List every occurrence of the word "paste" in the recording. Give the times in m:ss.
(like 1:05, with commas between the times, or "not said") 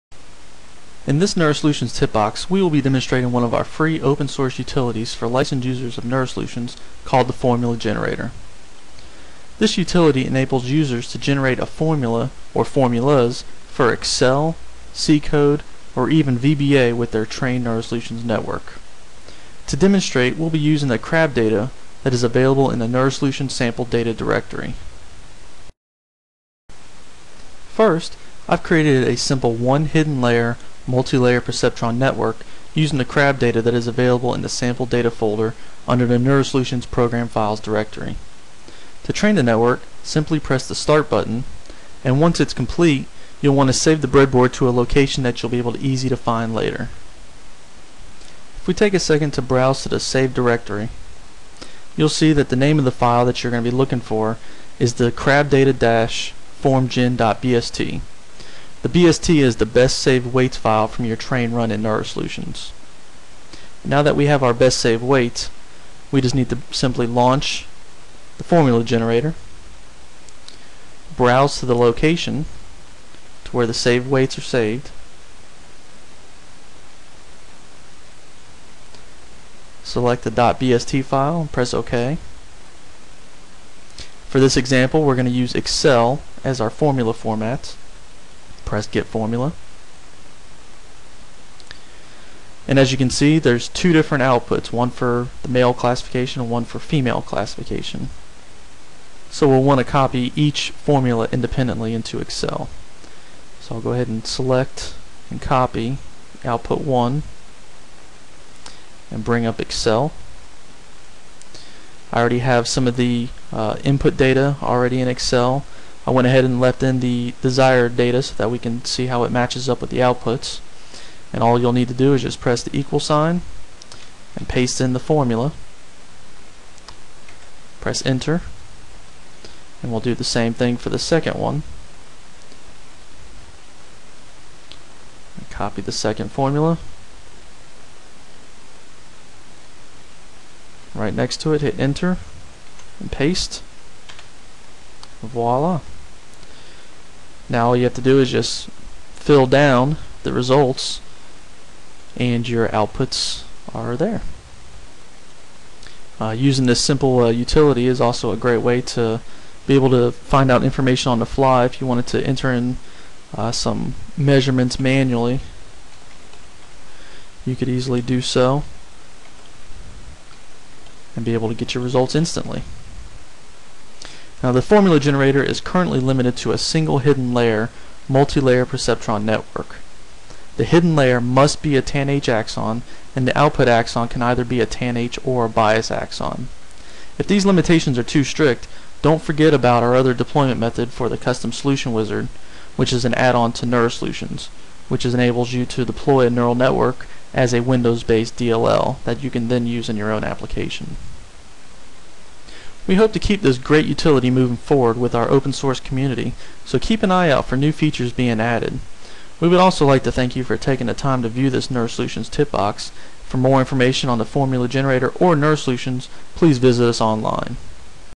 2:04, 2:23.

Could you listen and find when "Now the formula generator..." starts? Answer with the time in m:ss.
2:54.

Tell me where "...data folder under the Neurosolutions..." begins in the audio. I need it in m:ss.
0:34.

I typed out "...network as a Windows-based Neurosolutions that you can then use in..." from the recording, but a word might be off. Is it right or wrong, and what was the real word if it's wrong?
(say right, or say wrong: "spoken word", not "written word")
wrong: "DLL", not "Neurosolutions".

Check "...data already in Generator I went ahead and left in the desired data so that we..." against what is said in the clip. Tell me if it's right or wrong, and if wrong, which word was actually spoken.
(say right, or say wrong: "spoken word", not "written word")
wrong: "Excel", not "Generator".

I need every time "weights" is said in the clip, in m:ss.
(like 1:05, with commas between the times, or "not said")
1:00, 1:05, 1:14.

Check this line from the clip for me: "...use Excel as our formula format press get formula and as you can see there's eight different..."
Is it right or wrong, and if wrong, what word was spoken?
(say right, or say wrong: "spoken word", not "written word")
wrong: "two", not "eight".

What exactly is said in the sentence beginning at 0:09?
This utility enables users to generate a formula or formulas for Excel, C code, or even VBA with their trained NeuroSolutions network.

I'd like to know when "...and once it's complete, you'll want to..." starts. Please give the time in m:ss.
0:42.